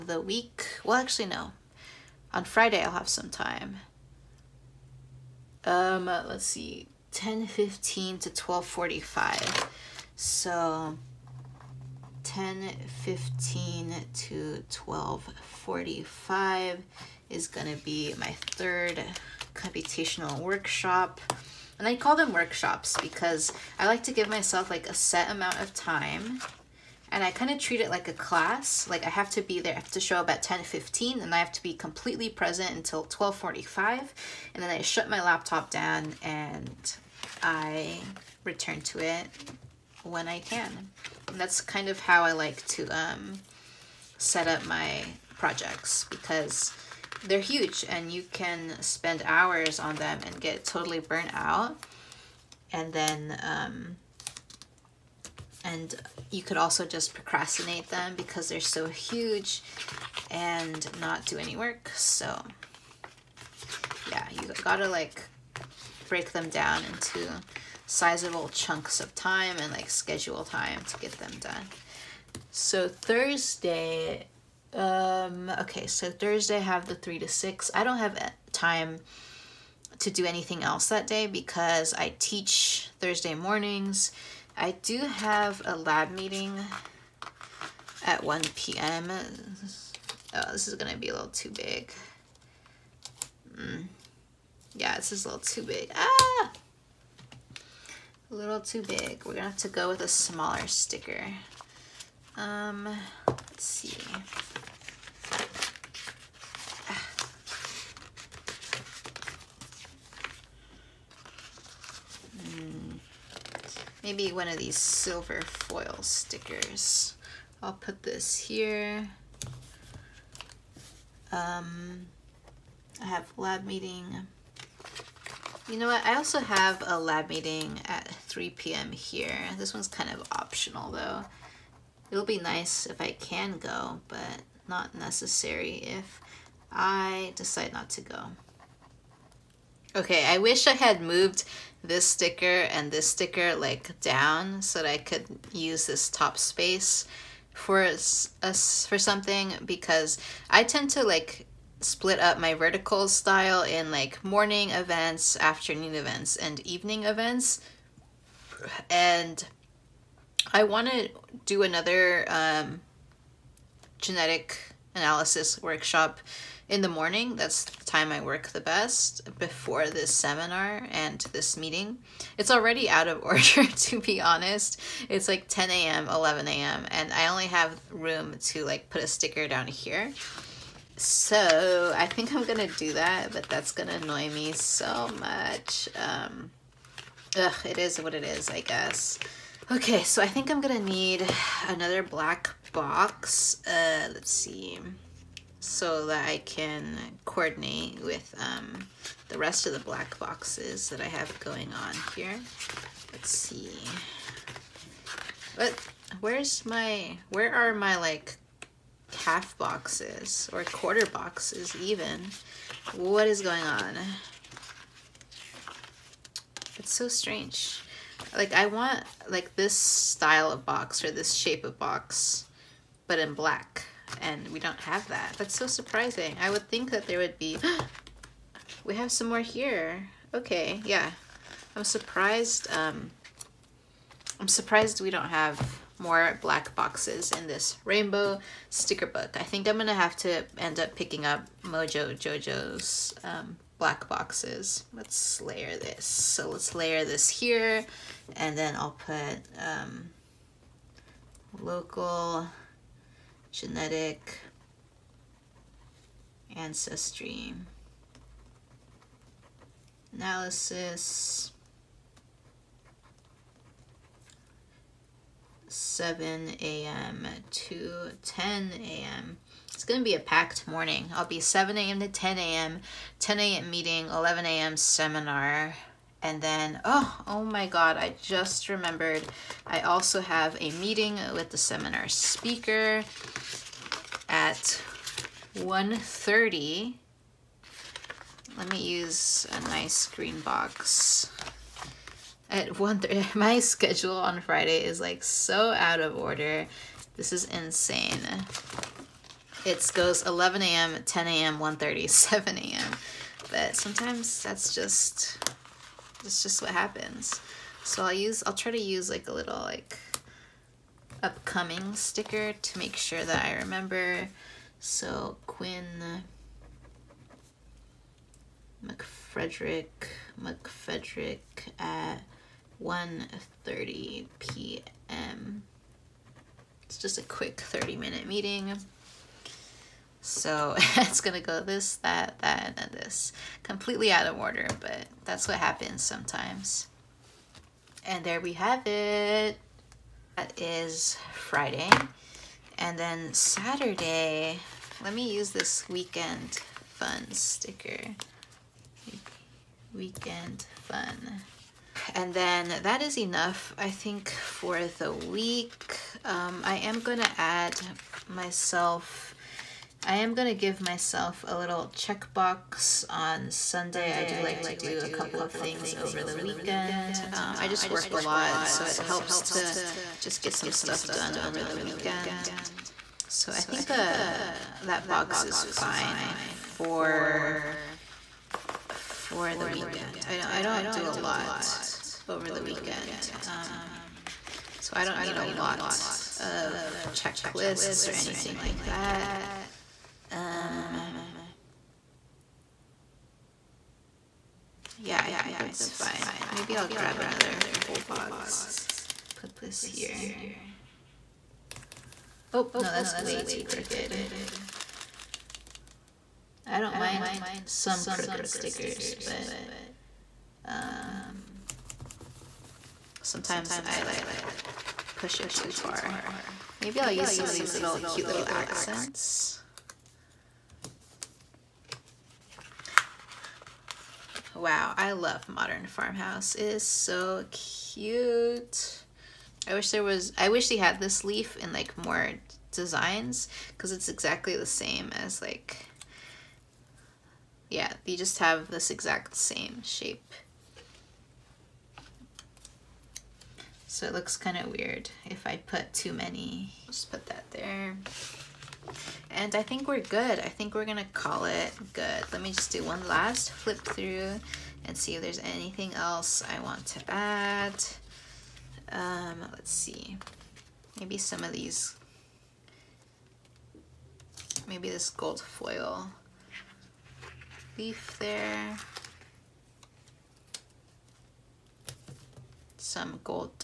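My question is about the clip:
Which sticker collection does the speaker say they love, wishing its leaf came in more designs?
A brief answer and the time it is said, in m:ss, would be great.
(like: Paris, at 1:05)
Modern Farmhouse, at 7:05.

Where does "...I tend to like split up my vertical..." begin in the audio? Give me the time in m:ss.
2:30.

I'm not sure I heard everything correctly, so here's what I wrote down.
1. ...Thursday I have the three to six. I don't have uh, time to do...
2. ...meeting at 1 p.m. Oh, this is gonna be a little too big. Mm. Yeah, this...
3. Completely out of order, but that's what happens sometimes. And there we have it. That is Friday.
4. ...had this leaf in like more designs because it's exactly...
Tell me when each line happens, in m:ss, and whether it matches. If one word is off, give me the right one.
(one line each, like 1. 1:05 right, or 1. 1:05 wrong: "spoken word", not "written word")
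1. 1:16 right
2. 1:26 right
3. 5:33 right
4. 7:10 right.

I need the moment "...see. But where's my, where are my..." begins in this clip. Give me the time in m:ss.
3:23.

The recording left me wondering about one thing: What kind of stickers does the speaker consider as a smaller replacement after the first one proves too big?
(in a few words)
Silver foil stickers.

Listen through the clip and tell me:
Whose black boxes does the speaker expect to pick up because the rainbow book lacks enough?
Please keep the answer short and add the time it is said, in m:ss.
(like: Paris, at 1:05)
Mojo Jojo's, at 4:01.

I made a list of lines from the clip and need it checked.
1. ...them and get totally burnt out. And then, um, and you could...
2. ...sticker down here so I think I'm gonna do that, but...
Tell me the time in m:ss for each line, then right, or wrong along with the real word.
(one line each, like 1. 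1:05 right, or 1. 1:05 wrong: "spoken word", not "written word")
1. 0:49 right
2. 2:59 right.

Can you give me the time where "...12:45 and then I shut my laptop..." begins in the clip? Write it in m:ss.
0:33.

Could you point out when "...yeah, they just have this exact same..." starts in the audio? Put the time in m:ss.
7:17.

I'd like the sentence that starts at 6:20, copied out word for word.
I don't, I don't do a lot over the weekend.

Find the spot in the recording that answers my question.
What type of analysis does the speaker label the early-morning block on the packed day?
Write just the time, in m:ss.
4:11.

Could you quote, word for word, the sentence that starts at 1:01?
So yeah, you gotta like break them down into sizable chunks of time and like schedule time to get them done.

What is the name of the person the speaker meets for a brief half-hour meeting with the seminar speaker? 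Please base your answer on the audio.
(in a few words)
Quinn McFrederick.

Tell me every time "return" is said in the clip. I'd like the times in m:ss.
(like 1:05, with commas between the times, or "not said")
0:38.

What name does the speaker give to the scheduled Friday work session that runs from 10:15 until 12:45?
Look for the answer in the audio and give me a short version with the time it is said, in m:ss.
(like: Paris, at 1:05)
Computational workshop, at 0:19.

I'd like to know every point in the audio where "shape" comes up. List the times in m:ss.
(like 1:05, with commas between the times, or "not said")
3:41, 7:19.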